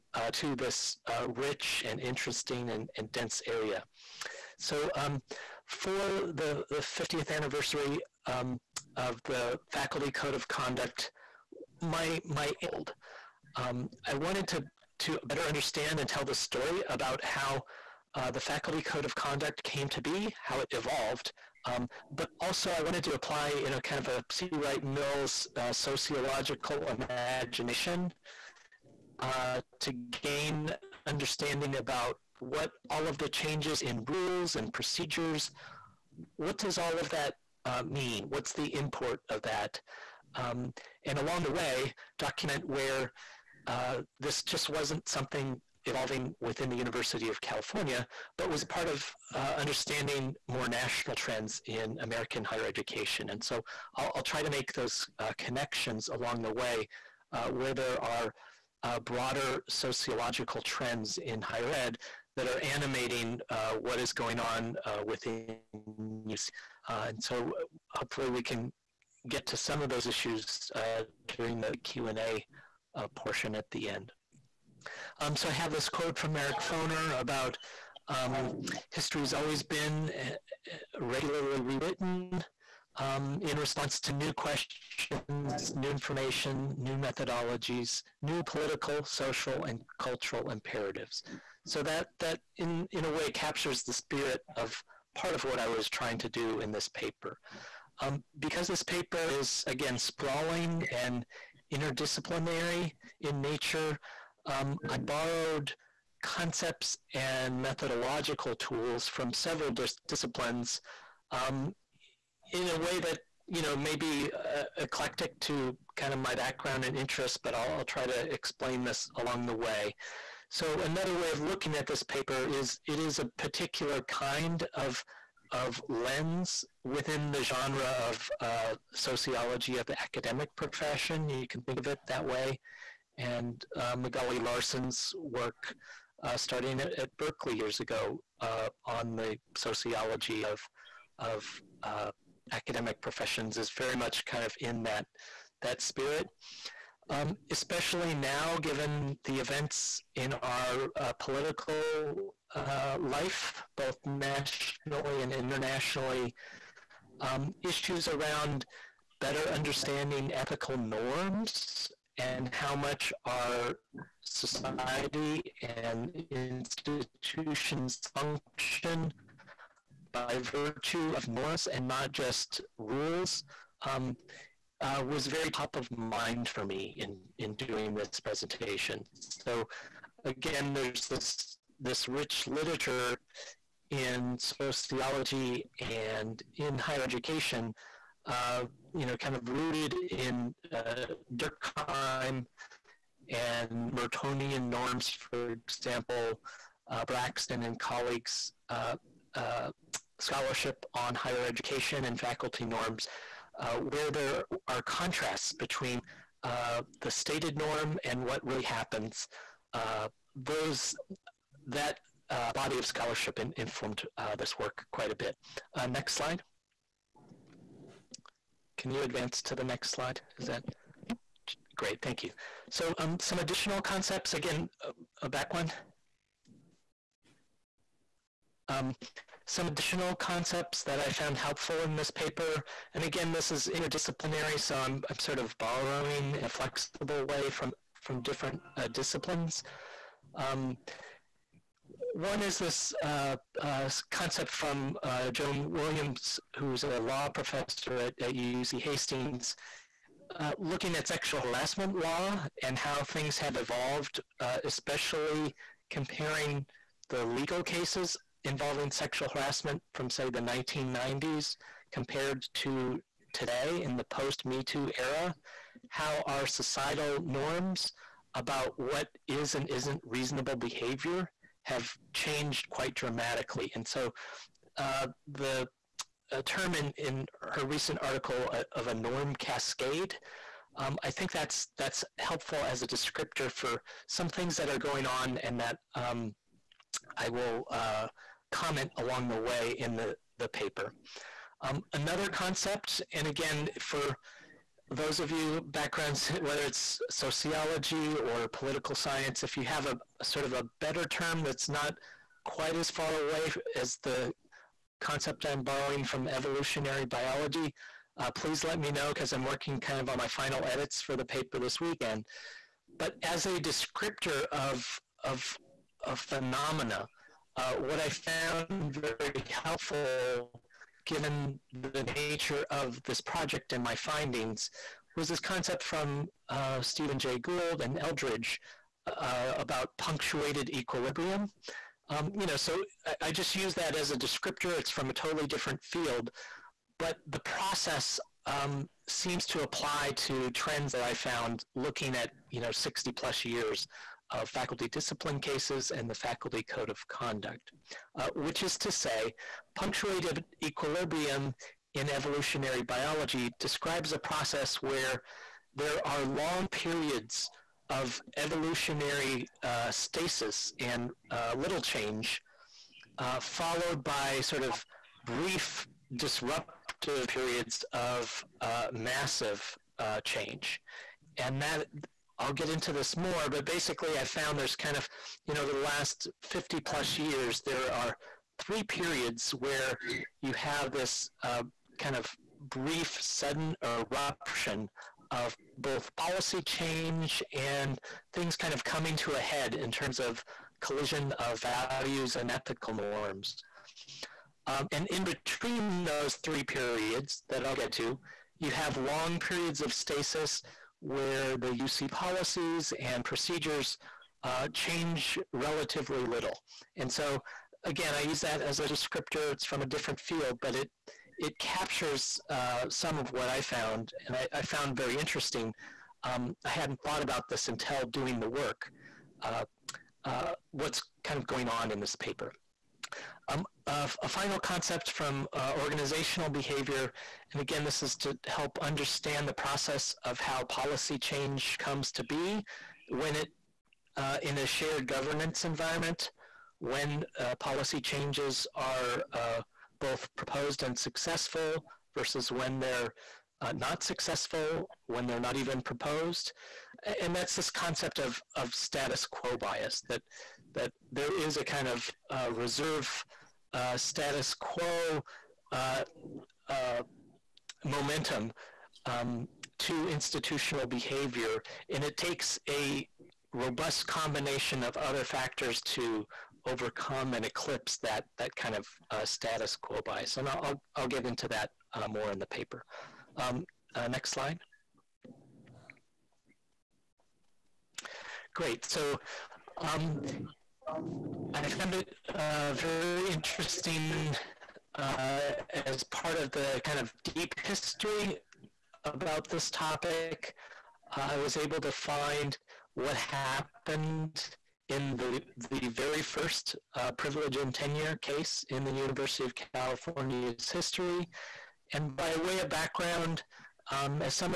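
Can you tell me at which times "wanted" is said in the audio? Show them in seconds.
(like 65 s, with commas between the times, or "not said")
14 s, 22 s.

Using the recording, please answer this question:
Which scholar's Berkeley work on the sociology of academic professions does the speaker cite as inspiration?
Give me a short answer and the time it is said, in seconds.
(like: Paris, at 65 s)
Magali Larson, at 133 s.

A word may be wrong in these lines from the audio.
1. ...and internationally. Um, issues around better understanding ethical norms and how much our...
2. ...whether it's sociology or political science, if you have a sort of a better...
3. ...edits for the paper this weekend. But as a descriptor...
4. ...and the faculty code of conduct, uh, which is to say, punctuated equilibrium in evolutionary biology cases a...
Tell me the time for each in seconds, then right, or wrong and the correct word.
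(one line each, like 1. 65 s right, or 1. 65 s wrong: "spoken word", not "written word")
1. 155 s right
2. 296 s right
3. 310 s right
4. 345 s wrong: "describes", not "cases".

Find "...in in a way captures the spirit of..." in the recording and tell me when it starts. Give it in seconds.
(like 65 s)
92 s.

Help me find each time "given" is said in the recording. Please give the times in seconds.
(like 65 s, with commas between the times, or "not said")
148 s, 321 s.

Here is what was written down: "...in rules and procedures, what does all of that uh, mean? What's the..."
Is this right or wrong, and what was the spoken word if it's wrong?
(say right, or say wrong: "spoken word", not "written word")
right.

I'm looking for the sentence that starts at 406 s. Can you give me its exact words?
And so again, I use that as a descriptor.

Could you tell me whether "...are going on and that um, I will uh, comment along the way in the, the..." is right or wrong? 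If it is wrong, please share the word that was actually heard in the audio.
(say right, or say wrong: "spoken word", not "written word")
right.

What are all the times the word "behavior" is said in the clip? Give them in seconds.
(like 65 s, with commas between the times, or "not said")
270 s, 426 s, 460 s.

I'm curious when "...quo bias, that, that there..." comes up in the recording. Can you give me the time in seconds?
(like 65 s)
449 s.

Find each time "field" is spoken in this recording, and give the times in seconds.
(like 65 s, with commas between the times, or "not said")
335 s, 410 s.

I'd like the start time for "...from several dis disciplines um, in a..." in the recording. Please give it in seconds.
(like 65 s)
109 s.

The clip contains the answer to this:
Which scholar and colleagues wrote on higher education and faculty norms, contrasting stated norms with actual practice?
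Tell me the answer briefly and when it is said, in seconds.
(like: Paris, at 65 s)
Braxton, at 197 s.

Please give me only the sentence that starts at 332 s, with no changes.
Um, you know, so I, I just use that as a descriptor.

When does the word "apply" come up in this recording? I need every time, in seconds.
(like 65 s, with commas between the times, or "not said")
23 s, 339 s.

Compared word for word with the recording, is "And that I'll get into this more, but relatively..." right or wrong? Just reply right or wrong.
wrong.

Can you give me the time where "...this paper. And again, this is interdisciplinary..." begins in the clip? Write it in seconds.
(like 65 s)
231 s.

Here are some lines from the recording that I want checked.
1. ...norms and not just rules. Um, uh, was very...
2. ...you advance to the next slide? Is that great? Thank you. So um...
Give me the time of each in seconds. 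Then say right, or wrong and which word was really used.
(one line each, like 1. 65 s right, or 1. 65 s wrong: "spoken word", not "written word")
1. 171 s right
2. 218 s right.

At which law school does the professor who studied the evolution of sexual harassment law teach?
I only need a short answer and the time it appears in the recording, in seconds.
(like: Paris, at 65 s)
UC Hastings, at 248 s.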